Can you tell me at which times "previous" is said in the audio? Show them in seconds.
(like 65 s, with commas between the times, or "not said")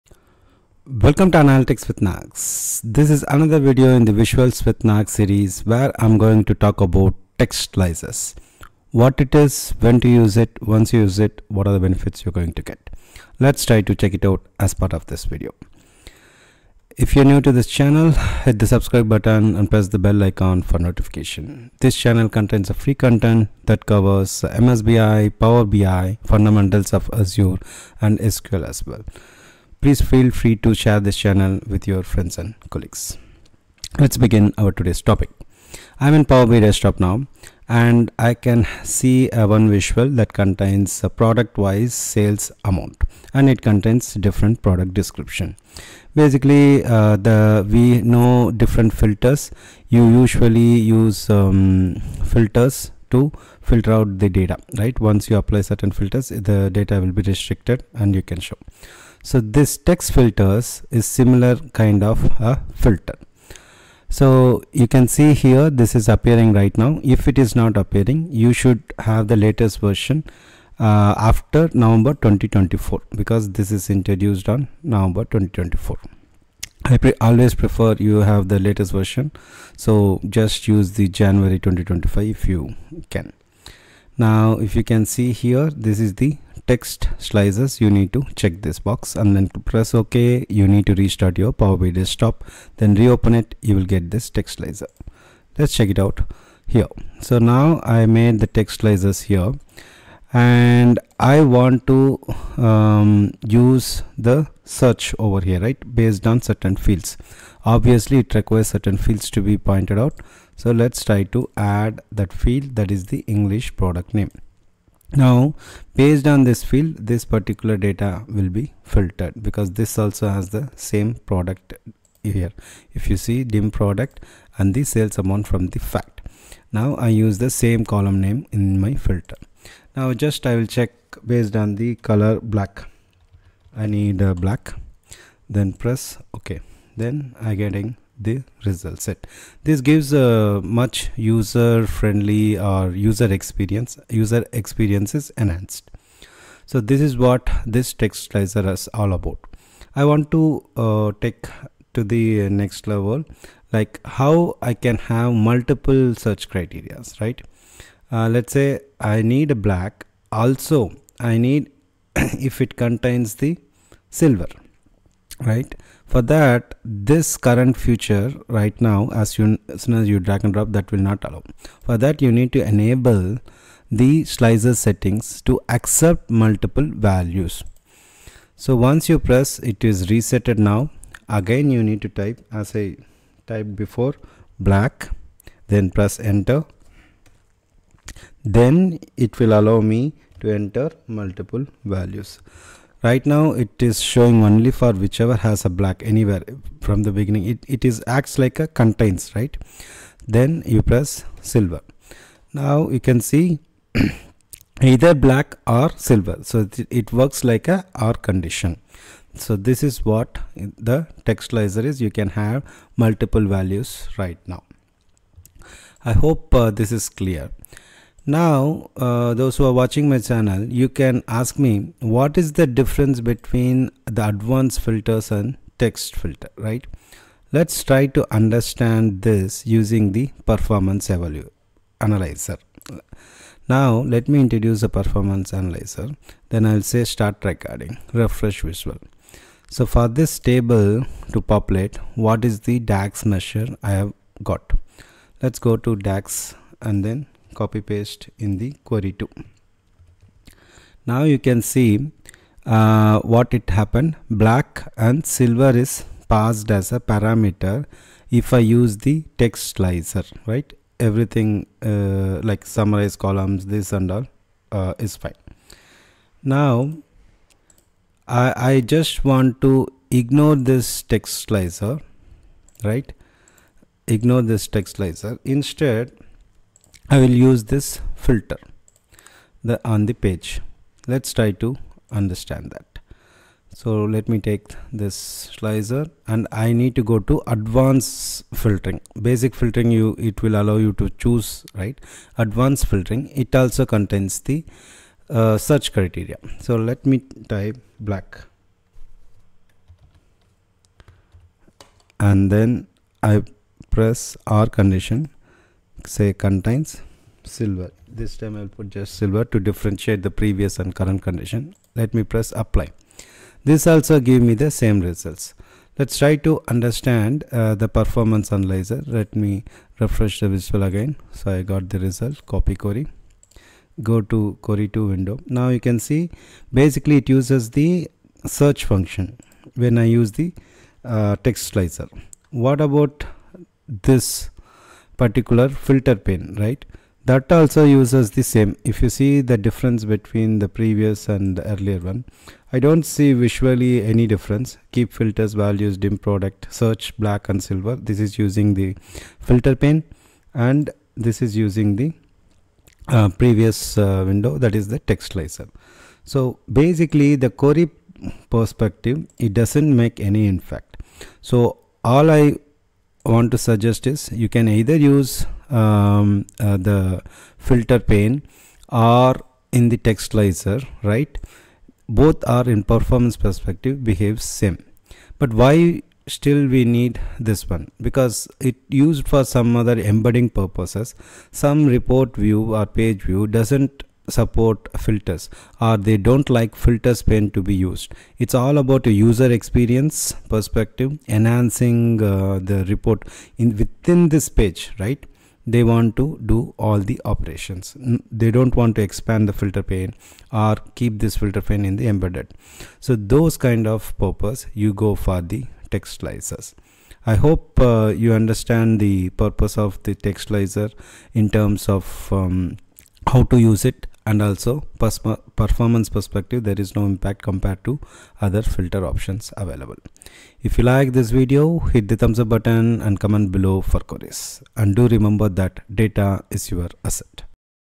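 310 s, 340 s, 353 s.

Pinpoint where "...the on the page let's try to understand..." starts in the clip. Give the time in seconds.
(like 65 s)
279 s.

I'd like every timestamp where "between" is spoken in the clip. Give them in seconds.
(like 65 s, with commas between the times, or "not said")
223 s, 340 s.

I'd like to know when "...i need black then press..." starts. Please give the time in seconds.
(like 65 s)
133 s.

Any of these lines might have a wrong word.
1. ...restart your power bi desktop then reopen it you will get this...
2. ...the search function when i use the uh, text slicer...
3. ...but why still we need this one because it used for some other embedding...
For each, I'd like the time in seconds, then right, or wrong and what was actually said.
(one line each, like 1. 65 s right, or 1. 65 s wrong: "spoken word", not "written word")
1. 90 s right
2. 327 s right
3. 375 s right.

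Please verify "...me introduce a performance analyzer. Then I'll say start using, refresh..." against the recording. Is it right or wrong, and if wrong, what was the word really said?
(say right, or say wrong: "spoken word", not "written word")
wrong: "recording", not "using".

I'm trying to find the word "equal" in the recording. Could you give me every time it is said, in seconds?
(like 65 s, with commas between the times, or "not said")
not said.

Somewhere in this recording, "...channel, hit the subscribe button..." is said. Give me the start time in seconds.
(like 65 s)
17 s.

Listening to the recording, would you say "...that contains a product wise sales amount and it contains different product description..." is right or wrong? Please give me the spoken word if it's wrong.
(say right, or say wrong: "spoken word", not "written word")
right.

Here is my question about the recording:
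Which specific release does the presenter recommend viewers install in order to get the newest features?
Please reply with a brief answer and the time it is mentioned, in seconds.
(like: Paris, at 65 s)
January 2025, at 81 s.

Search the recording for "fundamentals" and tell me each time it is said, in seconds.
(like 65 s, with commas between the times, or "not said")
26 s.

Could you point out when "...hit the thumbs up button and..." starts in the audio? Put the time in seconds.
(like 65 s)
421 s.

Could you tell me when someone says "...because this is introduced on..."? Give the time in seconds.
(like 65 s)
73 s.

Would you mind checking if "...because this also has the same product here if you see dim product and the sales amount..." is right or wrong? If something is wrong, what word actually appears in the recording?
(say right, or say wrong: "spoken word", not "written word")
right.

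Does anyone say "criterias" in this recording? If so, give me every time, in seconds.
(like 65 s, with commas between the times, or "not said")
156 s, 295 s.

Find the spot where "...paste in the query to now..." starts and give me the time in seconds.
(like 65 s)
247 s.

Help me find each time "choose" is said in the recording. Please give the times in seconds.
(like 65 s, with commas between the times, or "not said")
291 s.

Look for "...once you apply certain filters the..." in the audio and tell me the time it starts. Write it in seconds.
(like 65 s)
54 s.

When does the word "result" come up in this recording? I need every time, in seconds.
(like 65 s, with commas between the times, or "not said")
138 s, 315 s, 321 s.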